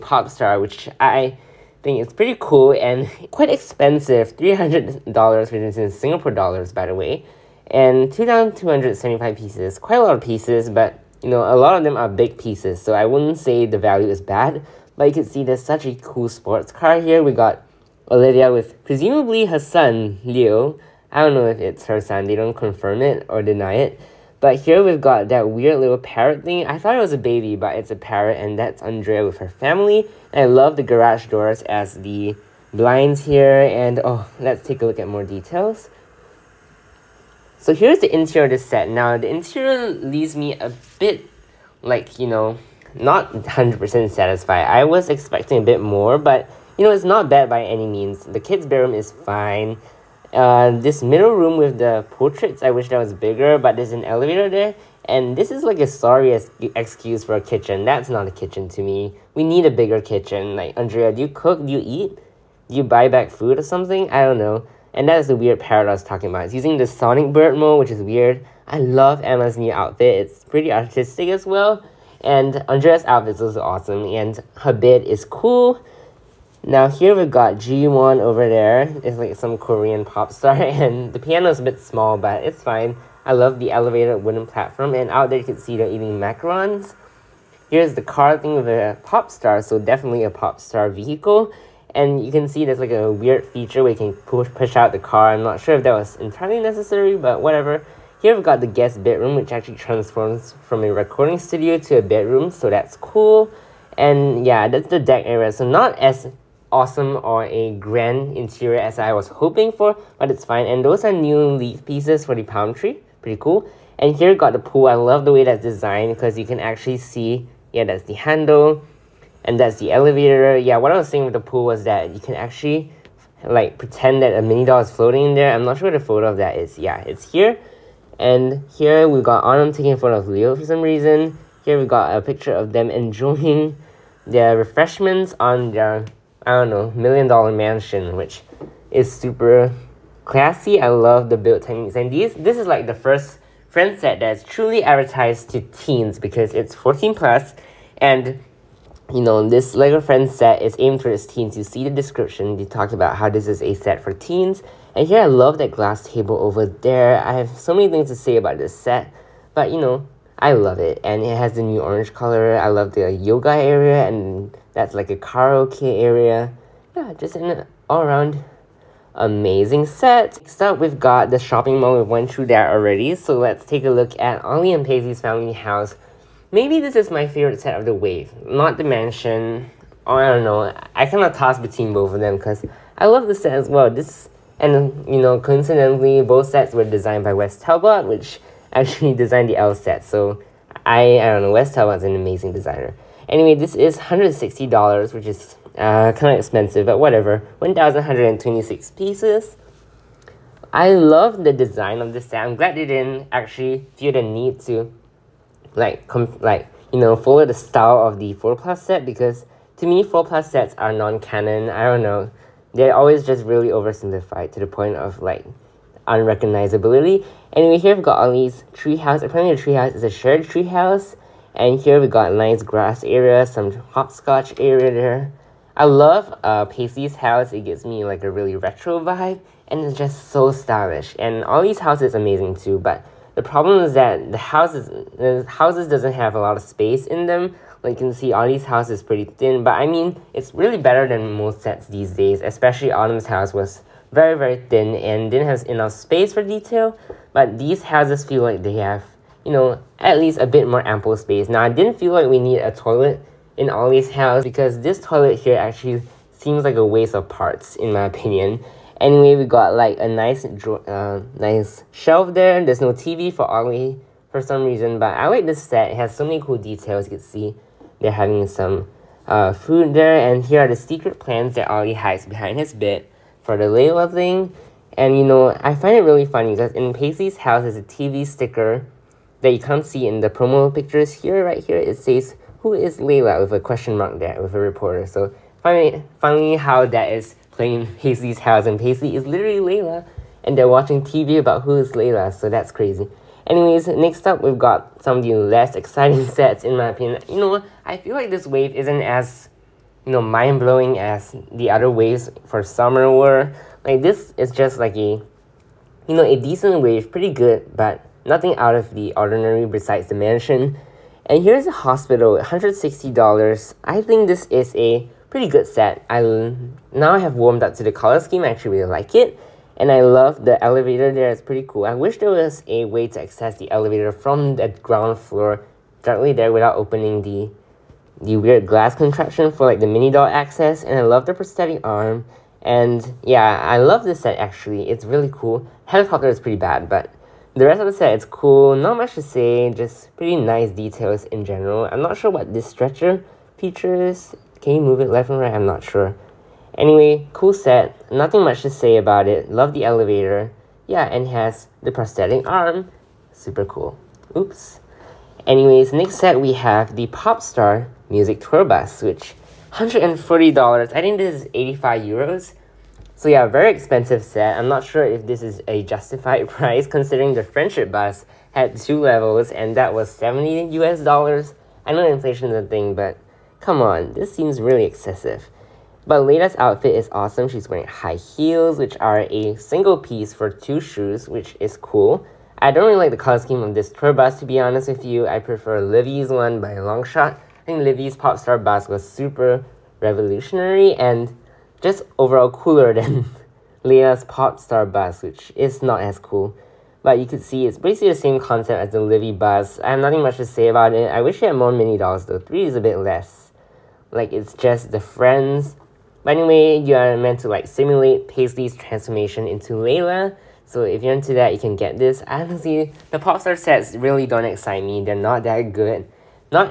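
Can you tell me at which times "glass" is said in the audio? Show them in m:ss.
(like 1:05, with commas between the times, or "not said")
2:35, 5:28.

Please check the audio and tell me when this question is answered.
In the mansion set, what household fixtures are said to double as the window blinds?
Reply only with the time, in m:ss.
0:30.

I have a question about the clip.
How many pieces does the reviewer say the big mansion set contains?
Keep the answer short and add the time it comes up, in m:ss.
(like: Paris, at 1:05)
2,275, at 0:08.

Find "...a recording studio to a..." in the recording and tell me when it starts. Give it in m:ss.
1:40.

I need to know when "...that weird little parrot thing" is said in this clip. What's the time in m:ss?
0:25.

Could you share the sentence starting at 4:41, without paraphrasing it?
Here, right here, it says, who is Layla with a question mark there with a reporter.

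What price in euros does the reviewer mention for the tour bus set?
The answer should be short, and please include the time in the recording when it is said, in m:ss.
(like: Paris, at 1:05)
85 euros, at 6:01.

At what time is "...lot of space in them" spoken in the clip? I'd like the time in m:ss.
3:56.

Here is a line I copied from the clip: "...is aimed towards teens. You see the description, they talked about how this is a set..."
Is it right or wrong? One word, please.
right.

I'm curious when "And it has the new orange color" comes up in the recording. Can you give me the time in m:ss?
2:41.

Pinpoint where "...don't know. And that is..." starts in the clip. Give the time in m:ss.
1:04.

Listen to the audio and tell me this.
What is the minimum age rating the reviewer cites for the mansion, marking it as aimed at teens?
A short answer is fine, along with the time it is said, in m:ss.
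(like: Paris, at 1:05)
14+, at 2:26.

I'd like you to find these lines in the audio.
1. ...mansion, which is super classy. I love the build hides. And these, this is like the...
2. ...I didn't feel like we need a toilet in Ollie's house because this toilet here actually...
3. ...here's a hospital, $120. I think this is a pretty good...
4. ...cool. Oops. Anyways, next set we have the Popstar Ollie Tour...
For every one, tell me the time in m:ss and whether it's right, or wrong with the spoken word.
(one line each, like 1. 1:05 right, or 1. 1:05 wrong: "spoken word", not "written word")
1. 2:17 wrong: "techniques", not "hides"
2. 4:11 right
3. 5:11 wrong: "160", not "120"
4. 5:53 wrong: "Music", not "Ollie".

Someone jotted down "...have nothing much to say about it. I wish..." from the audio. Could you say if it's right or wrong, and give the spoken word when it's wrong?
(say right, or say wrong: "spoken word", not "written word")
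right.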